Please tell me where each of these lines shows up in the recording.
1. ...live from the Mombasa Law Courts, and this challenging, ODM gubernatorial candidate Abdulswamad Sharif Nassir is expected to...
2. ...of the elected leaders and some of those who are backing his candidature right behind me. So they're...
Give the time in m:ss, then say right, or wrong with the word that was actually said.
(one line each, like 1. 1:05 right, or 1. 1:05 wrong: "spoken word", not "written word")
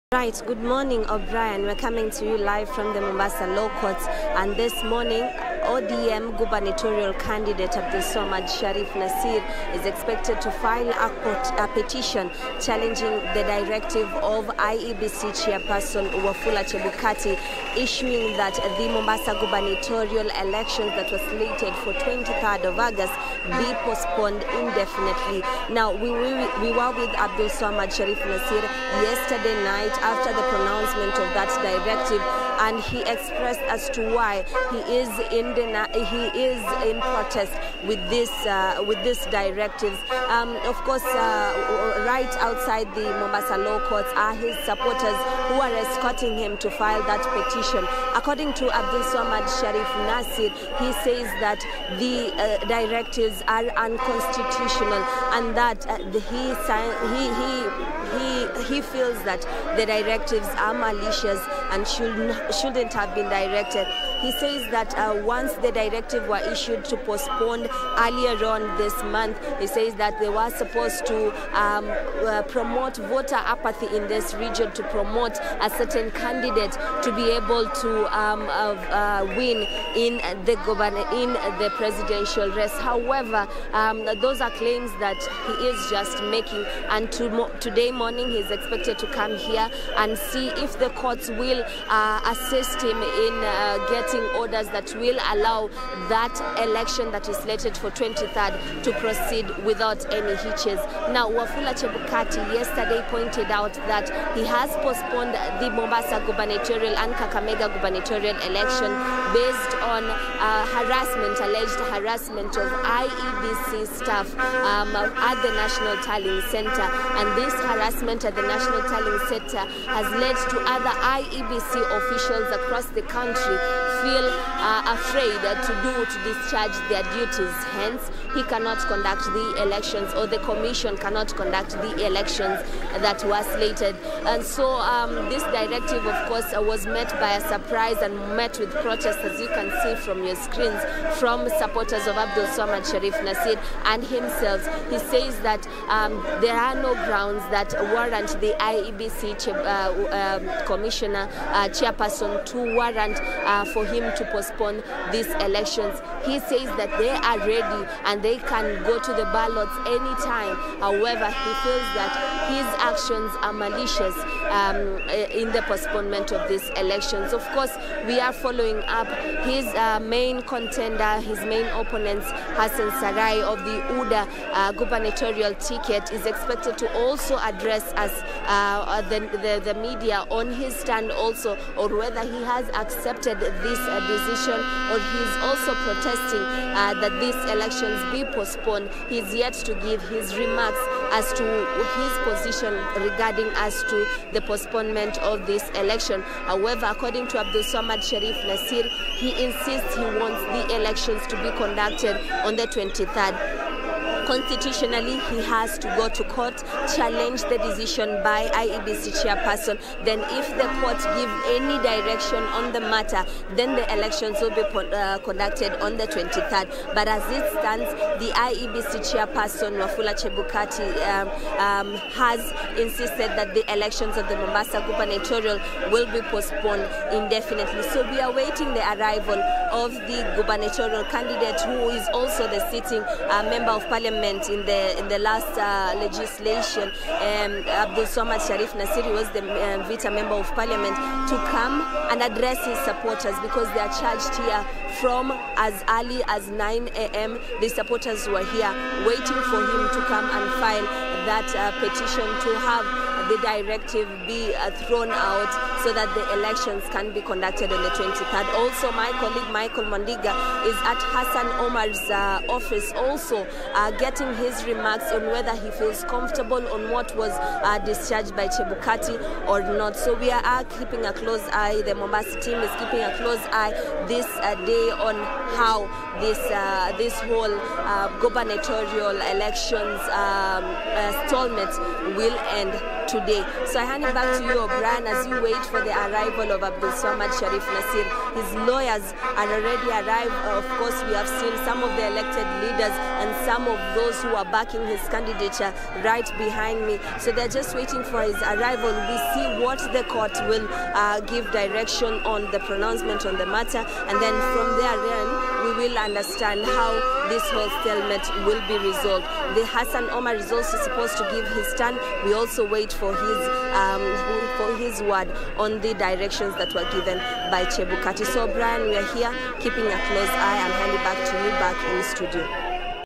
1. 0:02 wrong: "morning", not "challenging"
2. 4:51 right.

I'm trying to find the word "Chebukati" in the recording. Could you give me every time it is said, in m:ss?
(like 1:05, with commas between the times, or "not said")
0:16, 1:41, 3:40, 4:28, 5:17.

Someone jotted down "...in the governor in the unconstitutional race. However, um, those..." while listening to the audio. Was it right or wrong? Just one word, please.
wrong.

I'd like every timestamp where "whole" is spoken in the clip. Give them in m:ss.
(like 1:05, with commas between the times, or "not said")
4:37, 5:07.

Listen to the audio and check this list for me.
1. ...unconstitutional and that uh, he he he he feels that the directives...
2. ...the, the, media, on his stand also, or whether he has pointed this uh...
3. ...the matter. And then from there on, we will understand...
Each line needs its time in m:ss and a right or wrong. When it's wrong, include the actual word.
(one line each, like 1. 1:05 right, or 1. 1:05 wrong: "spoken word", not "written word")
1. 0:53 right
2. 2:59 wrong: "accepted", not "pointed"
3. 5:03 right.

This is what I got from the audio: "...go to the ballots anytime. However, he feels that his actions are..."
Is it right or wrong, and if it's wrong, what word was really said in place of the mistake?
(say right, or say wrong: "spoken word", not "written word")
right.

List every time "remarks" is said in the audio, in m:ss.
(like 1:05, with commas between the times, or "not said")
3:10, 4:24.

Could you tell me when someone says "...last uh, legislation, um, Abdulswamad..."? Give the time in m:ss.
3:55.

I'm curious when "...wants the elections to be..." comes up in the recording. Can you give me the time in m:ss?
3:20.